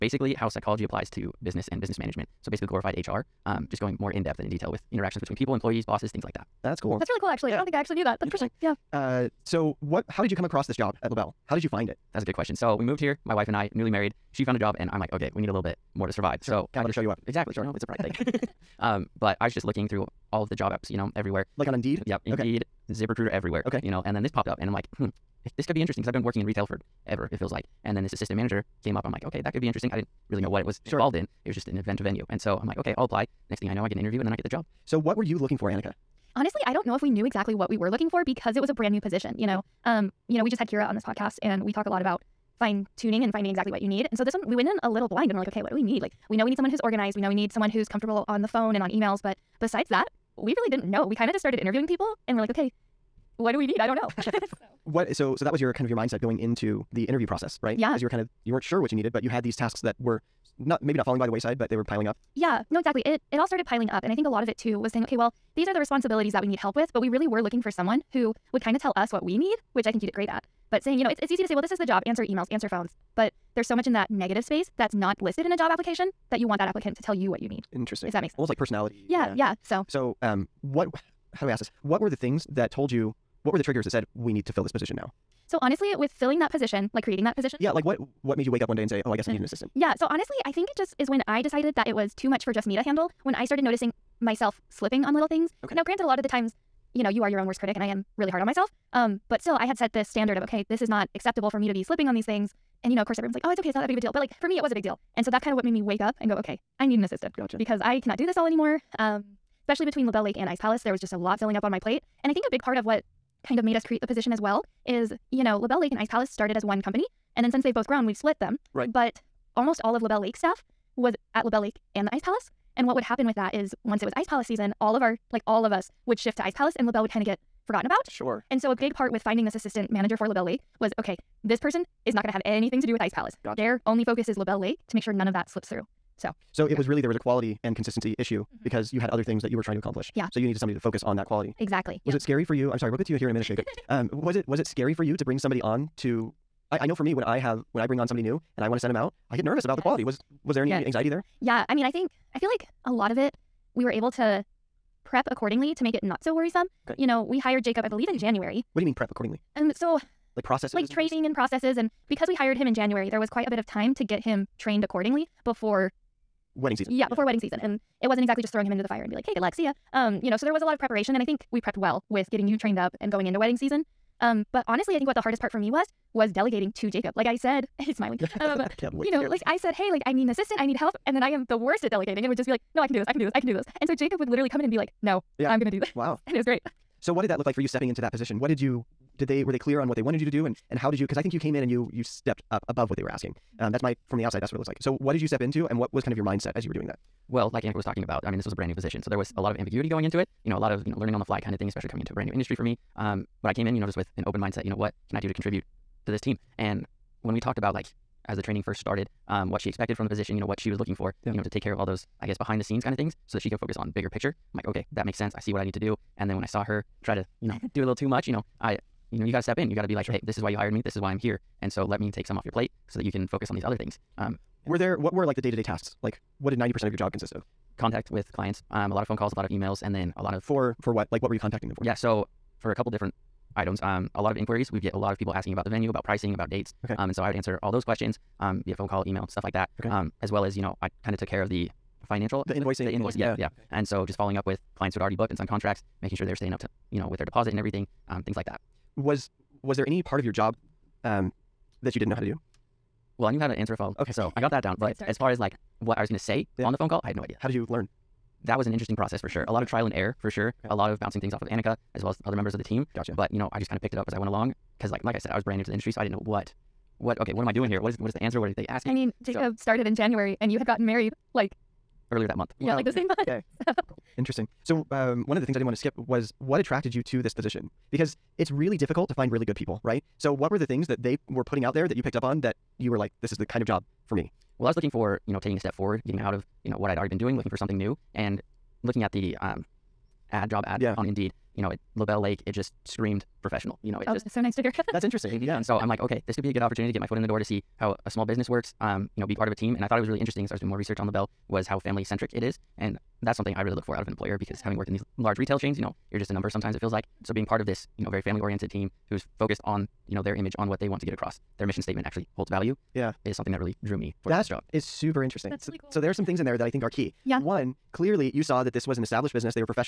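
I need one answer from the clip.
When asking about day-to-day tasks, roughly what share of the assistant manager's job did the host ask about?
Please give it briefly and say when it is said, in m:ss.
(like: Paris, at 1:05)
90%, at 3:46.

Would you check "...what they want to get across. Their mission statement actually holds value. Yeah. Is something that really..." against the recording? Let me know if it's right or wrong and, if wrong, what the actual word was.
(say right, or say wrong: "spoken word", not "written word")
right.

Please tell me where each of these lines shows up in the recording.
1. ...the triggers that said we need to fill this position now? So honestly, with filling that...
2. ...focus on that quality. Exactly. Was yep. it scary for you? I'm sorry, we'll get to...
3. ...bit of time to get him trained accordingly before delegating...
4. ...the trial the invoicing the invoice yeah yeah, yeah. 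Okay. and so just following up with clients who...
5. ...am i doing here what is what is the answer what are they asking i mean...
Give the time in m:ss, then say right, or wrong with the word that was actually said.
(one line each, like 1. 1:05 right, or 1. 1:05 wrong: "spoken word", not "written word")
1. 1:23 right
2. 2:20 right
3. 2:43 wrong: "wedding", not "delegating"
4. 4:01 wrong: "financial", not "trial"
5. 4:27 right.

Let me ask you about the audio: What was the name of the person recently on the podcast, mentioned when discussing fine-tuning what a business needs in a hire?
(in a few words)
Kira.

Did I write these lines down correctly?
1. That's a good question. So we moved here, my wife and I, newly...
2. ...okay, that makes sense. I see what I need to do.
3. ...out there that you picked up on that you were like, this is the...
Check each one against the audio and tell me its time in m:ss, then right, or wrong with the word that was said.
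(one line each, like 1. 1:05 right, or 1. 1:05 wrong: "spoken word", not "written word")
1. 0:12 right
2. 3:34 right
3. 4:41 right.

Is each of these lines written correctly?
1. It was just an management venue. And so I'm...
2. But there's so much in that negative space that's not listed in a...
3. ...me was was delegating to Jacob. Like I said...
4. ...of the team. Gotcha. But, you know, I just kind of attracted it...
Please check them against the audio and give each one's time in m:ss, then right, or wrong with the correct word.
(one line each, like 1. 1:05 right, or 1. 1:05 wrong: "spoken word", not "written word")
1. 0:31 wrong: "event", not "management"
2. 1:13 right
3. 2:55 right
4. 4:22 wrong: "picked", not "attracted".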